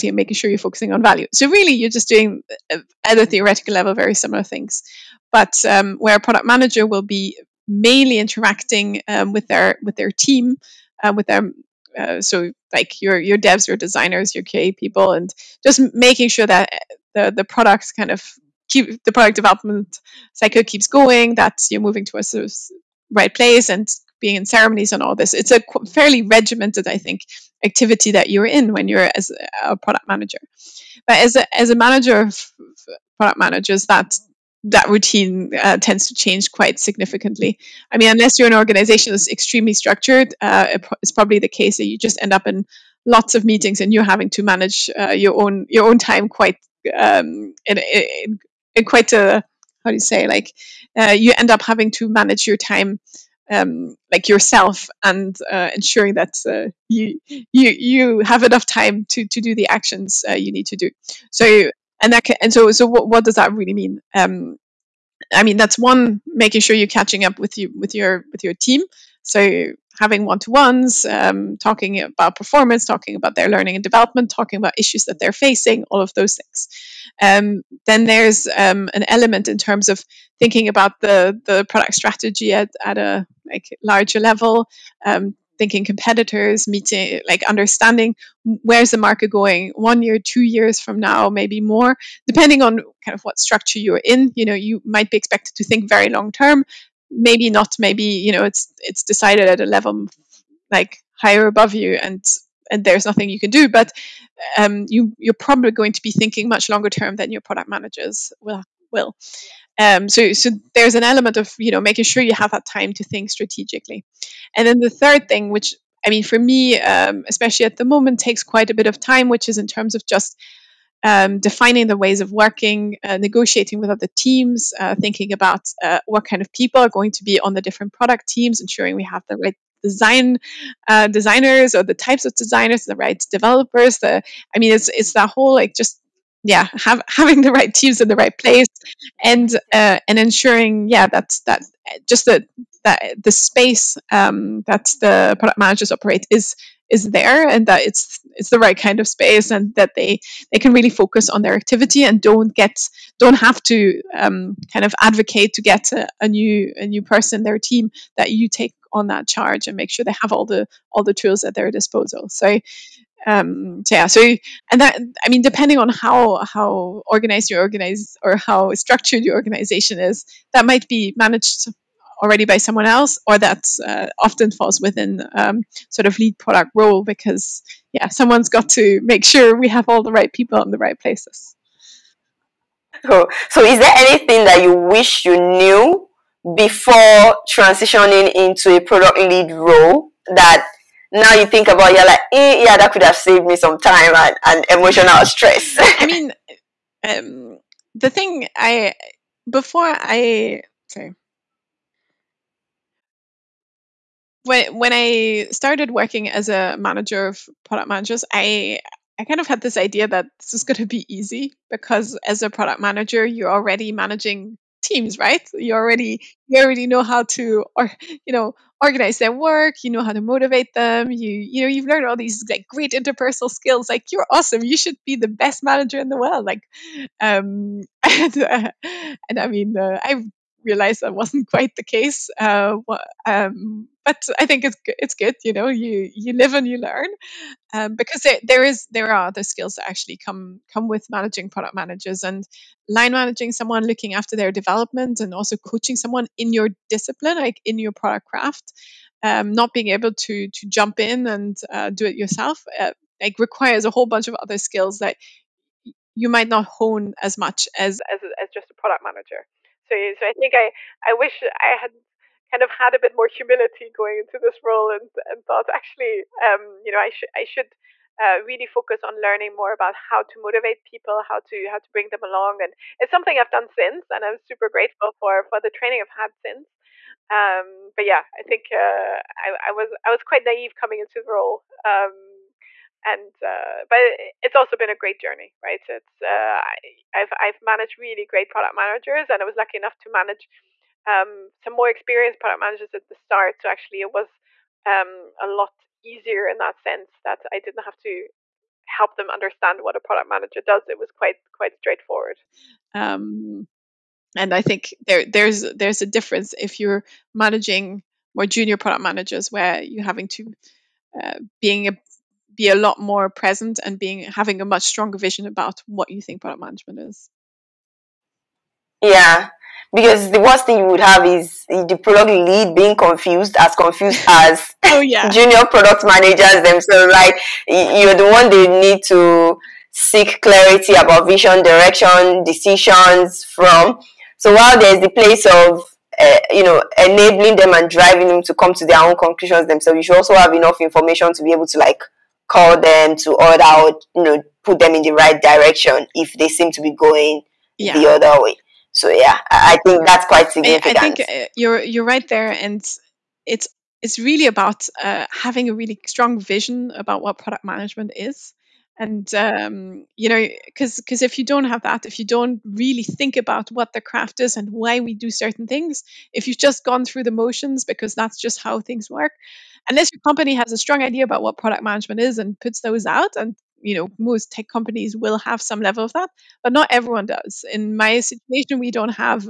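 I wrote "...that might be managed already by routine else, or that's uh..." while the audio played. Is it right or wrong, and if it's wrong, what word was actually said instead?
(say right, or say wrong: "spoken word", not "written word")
wrong: "someone", not "routine".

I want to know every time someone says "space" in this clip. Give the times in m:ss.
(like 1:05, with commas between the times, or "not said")
2:23, 2:29.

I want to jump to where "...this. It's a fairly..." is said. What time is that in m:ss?
0:25.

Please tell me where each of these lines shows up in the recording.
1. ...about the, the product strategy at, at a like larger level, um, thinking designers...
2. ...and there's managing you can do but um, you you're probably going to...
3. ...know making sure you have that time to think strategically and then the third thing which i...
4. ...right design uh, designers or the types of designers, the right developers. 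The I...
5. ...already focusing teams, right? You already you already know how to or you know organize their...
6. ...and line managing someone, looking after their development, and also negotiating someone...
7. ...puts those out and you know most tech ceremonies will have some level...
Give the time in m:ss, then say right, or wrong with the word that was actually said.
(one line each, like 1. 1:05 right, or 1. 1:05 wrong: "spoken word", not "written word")
1. 1:20 wrong: "competitors", not "designers"
2. 1:42 wrong: "nothing", not "managing"
3. 1:51 right
4. 2:09 right
5. 3:33 wrong: "managing", not "focusing"
6. 4:02 wrong: "coaching", not "negotiating"
7. 6:12 wrong: "companies", not "ceremonies".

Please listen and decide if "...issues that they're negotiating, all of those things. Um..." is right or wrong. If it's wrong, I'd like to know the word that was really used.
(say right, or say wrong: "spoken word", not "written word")
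wrong: "facing", not "negotiating".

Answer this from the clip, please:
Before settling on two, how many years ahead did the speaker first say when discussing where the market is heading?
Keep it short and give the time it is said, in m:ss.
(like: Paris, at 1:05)
1, at 1:29.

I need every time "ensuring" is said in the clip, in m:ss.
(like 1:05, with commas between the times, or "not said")
0:55, 2:08, 2:20.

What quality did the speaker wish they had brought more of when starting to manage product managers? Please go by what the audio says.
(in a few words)
humility.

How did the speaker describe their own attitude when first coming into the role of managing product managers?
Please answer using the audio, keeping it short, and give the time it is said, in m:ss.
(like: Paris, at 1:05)
naive, at 4:40.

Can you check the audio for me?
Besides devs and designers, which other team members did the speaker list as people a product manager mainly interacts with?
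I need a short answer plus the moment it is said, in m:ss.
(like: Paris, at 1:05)
QA people, at 0:14.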